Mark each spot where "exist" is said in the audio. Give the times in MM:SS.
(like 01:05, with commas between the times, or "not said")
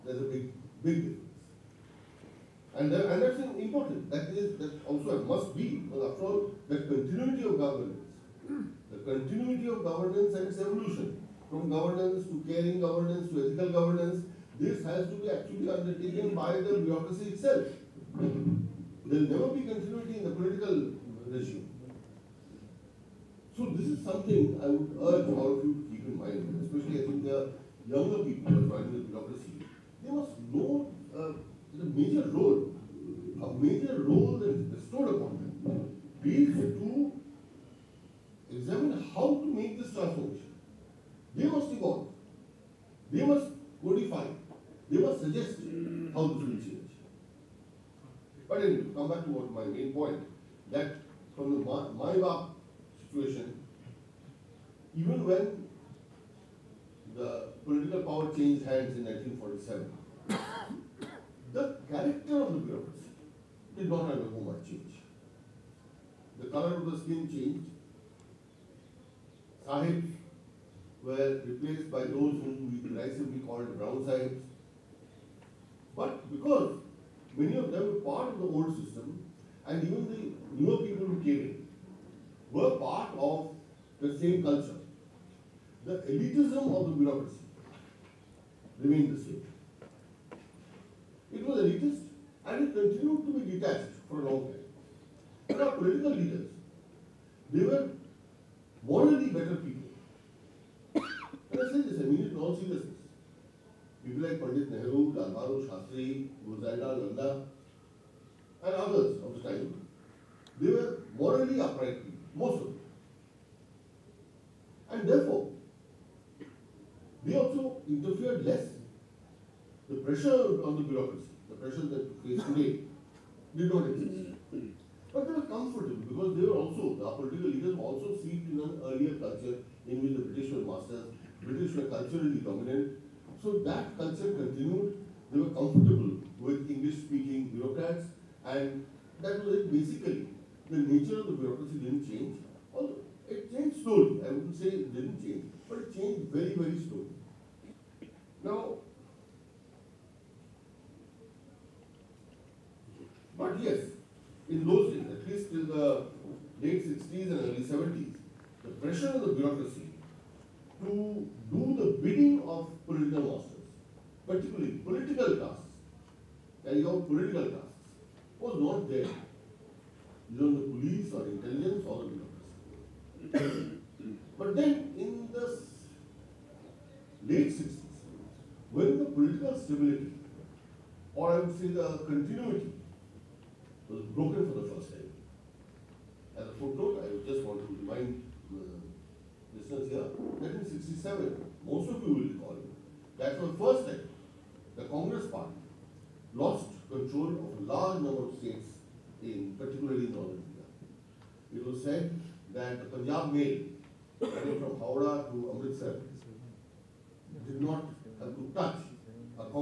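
02:03.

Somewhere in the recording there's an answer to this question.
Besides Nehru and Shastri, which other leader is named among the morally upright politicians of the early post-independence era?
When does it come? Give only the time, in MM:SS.
01:46.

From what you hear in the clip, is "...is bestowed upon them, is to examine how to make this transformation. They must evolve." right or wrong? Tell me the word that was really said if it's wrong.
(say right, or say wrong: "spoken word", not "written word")
right.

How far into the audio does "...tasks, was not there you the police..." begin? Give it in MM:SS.
02:47.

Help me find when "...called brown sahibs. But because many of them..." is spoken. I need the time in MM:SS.
01:13.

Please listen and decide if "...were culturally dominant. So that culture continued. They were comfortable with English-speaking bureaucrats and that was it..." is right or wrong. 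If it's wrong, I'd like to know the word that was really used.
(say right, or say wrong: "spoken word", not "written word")
right.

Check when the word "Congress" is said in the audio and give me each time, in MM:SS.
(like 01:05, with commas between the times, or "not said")
03:14.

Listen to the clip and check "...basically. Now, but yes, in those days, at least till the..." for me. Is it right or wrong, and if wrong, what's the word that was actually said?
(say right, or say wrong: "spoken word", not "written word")
wrong: "slowly", not "basically".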